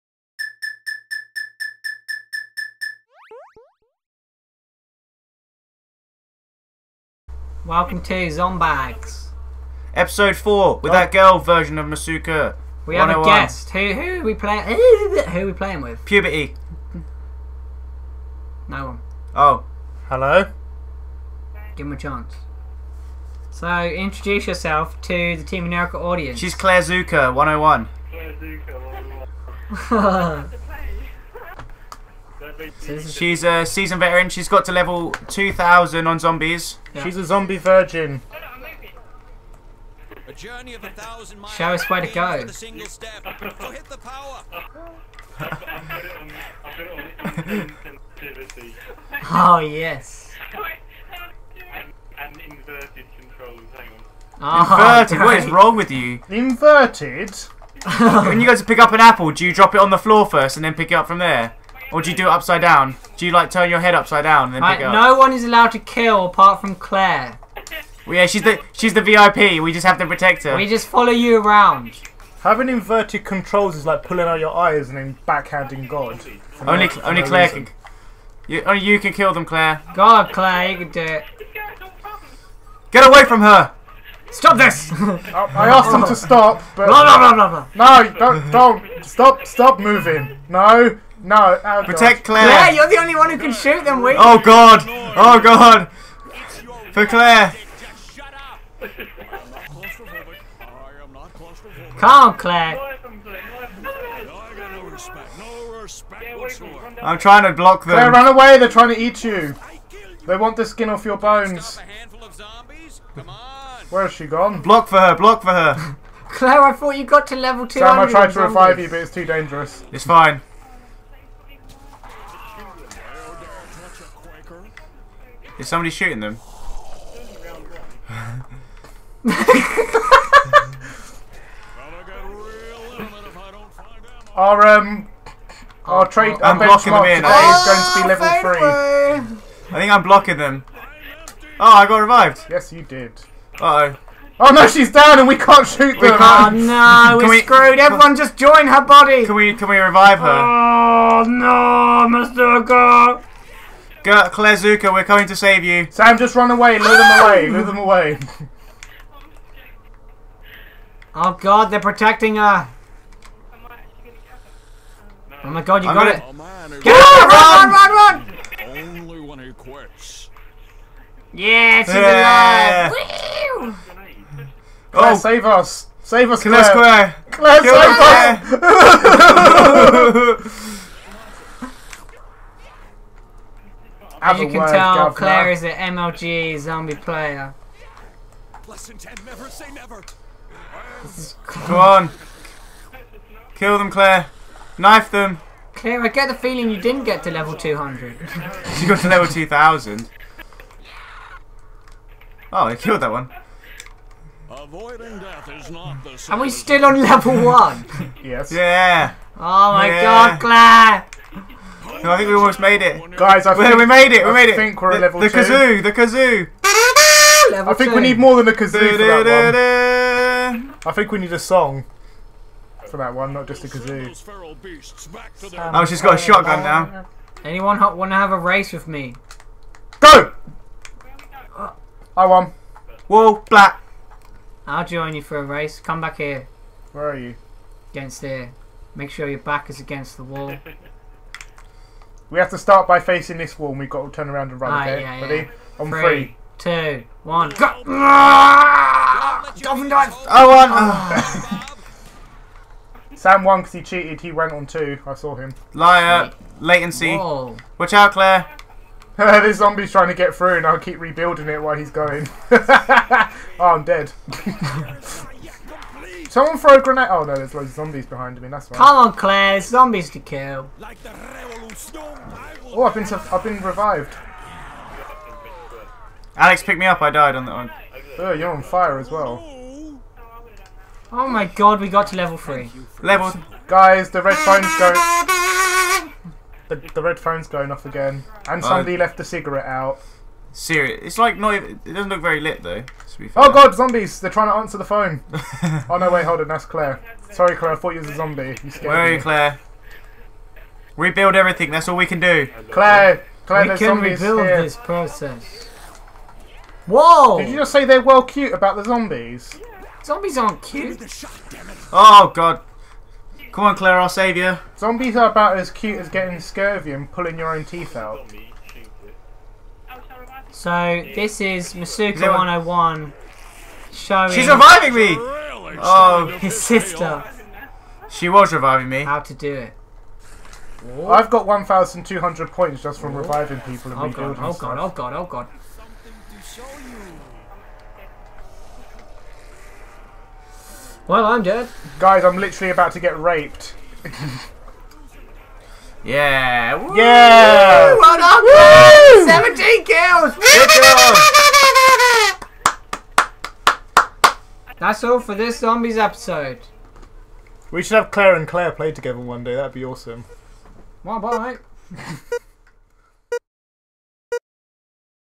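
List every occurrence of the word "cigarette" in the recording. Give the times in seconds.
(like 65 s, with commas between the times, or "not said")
289 s.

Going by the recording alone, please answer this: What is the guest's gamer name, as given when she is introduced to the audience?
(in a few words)
Claire Zuka 101.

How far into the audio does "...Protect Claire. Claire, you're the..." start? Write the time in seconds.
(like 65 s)
91 s.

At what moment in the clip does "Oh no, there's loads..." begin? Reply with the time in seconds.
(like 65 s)
267 s.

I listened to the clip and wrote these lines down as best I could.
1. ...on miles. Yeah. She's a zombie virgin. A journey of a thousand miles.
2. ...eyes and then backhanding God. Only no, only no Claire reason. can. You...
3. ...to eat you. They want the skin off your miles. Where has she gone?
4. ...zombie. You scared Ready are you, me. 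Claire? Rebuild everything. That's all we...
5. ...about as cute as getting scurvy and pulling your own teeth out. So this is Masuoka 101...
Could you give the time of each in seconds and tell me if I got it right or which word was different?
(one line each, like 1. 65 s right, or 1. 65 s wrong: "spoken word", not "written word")
1. 36 s wrong: "zombies", not "miles"
2. 74 s right
3. 108 s wrong: "bones", not "miles"
4. 298 s wrong: "Where", not "Ready"
5. 315 s right.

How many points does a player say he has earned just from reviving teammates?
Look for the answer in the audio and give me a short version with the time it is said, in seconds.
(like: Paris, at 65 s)
1,200, at 331 s.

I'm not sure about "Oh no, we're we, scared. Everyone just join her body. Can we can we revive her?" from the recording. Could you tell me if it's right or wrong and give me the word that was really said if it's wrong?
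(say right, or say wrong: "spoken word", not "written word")
wrong: "screwed", not "scared".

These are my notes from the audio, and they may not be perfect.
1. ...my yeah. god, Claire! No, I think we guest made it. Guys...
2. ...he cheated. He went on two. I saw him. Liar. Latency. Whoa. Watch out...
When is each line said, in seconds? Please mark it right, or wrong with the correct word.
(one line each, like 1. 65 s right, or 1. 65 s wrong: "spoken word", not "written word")
1. 209 s wrong: "almost", not "guest"
2. 253 s right.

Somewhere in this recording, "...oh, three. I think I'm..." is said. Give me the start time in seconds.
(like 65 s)
138 s.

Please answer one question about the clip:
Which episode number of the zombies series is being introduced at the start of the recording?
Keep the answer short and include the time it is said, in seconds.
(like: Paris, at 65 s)
4, at 9 s.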